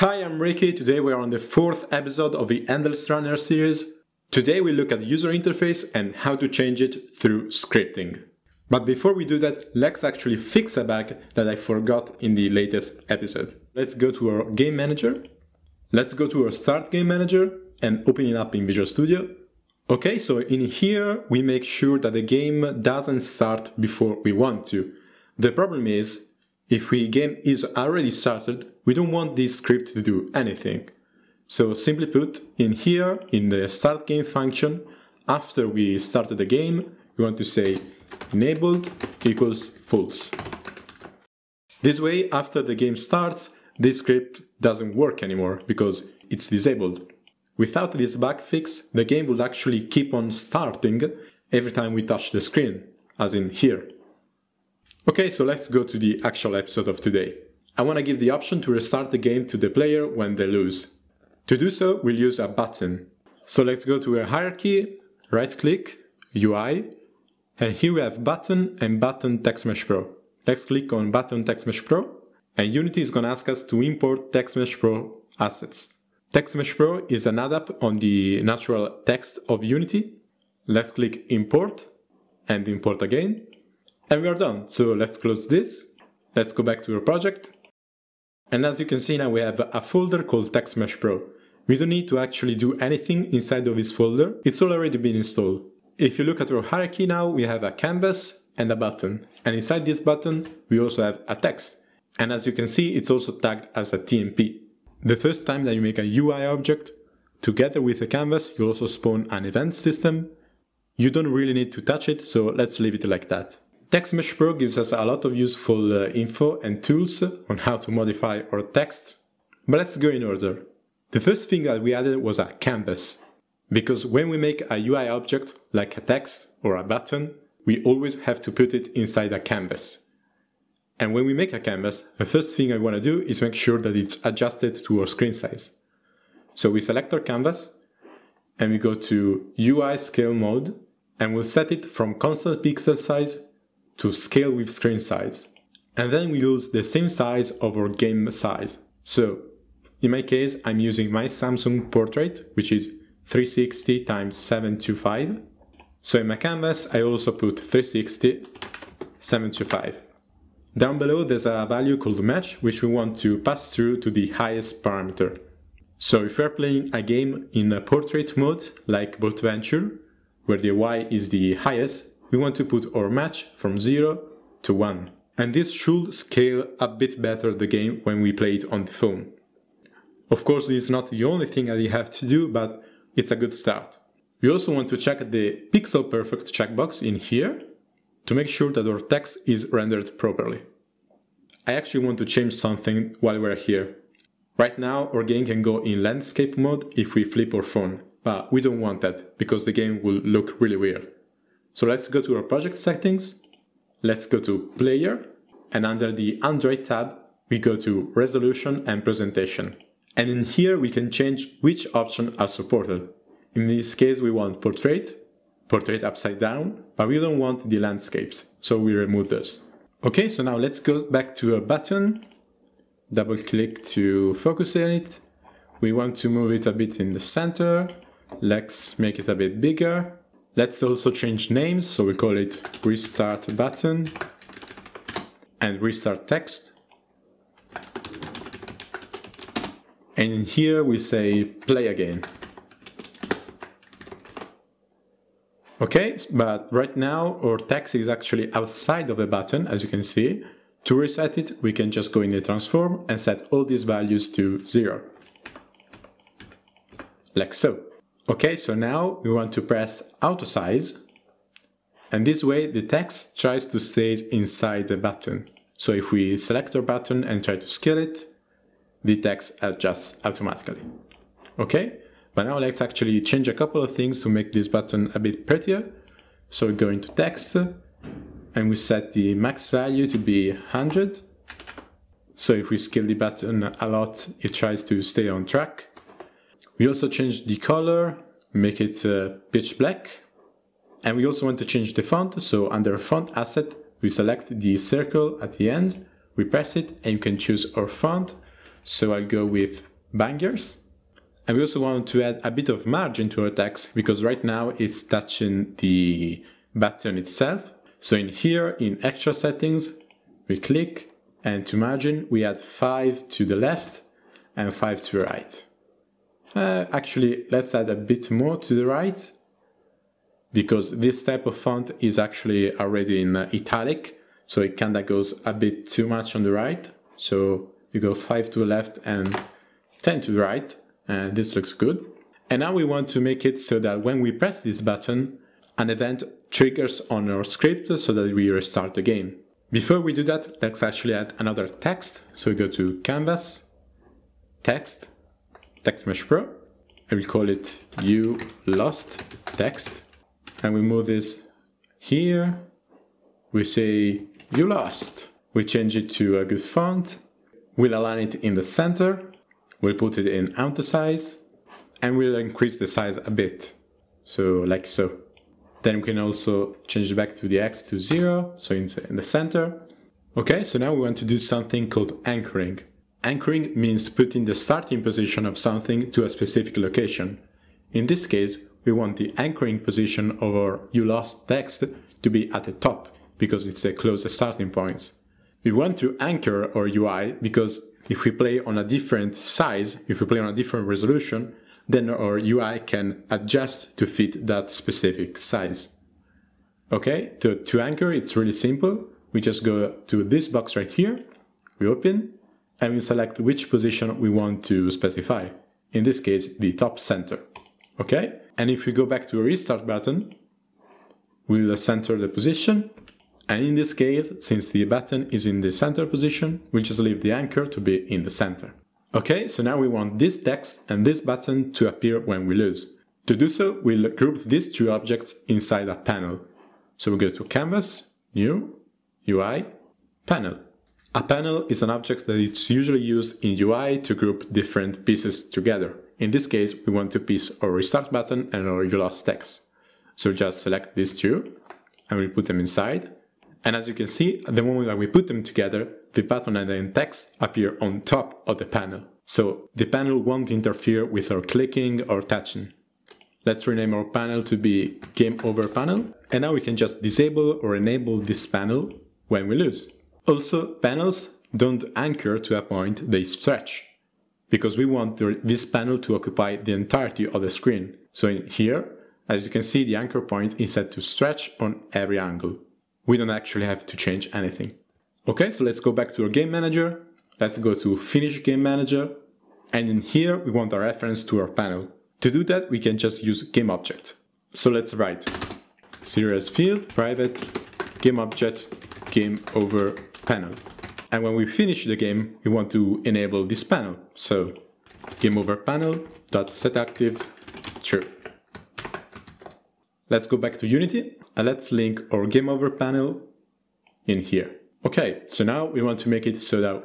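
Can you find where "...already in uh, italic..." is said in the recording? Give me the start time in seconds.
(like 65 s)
322 s.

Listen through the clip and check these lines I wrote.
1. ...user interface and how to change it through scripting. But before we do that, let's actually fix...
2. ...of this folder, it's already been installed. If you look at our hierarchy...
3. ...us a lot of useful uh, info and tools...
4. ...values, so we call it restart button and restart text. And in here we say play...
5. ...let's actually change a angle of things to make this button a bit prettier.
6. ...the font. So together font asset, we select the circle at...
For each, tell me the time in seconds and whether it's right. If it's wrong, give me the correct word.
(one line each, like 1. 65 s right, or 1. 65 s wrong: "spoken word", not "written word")
1. 5 s right
2. 93 s right
3. 114 s right
4. 231 s wrong: "names", not "values"
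5. 272 s wrong: "couple", not "angle"
6. 291 s wrong: "under", not "together".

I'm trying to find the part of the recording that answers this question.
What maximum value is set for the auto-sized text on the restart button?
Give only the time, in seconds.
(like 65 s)
280 s.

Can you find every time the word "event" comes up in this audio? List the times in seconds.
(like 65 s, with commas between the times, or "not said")
109 s, 335 s.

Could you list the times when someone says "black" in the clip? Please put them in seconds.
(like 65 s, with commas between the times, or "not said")
289 s.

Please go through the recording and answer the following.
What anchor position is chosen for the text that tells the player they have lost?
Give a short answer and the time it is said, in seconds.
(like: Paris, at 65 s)
Top center, at 406 s.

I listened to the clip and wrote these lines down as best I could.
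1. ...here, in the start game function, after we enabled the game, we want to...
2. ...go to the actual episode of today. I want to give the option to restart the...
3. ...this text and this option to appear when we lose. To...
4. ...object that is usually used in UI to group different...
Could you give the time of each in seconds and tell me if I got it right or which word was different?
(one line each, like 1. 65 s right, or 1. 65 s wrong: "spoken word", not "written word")
1. 32 s wrong: "started", not "enabled"
2. 55 s right
3. 420 s wrong: "button", not "option"
4. 431 s right.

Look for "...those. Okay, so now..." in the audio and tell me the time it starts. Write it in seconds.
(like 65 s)
219 s.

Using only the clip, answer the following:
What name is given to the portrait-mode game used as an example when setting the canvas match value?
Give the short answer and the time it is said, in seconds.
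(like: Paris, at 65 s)
BoatVenture, at 169 s.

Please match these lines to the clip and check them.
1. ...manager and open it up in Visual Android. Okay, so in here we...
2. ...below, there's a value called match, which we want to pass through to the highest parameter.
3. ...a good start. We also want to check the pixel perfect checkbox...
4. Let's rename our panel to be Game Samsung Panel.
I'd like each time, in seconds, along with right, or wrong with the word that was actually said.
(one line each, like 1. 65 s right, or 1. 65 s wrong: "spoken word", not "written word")
1. 17 s wrong: "Studio", not "Android"
2. 160 s right
3. 183 s right
4. 453 s wrong: "Over", not "Samsung".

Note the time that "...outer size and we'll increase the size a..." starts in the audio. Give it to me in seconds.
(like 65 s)
360 s.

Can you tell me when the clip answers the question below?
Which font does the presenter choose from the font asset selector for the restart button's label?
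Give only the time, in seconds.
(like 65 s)
300 s.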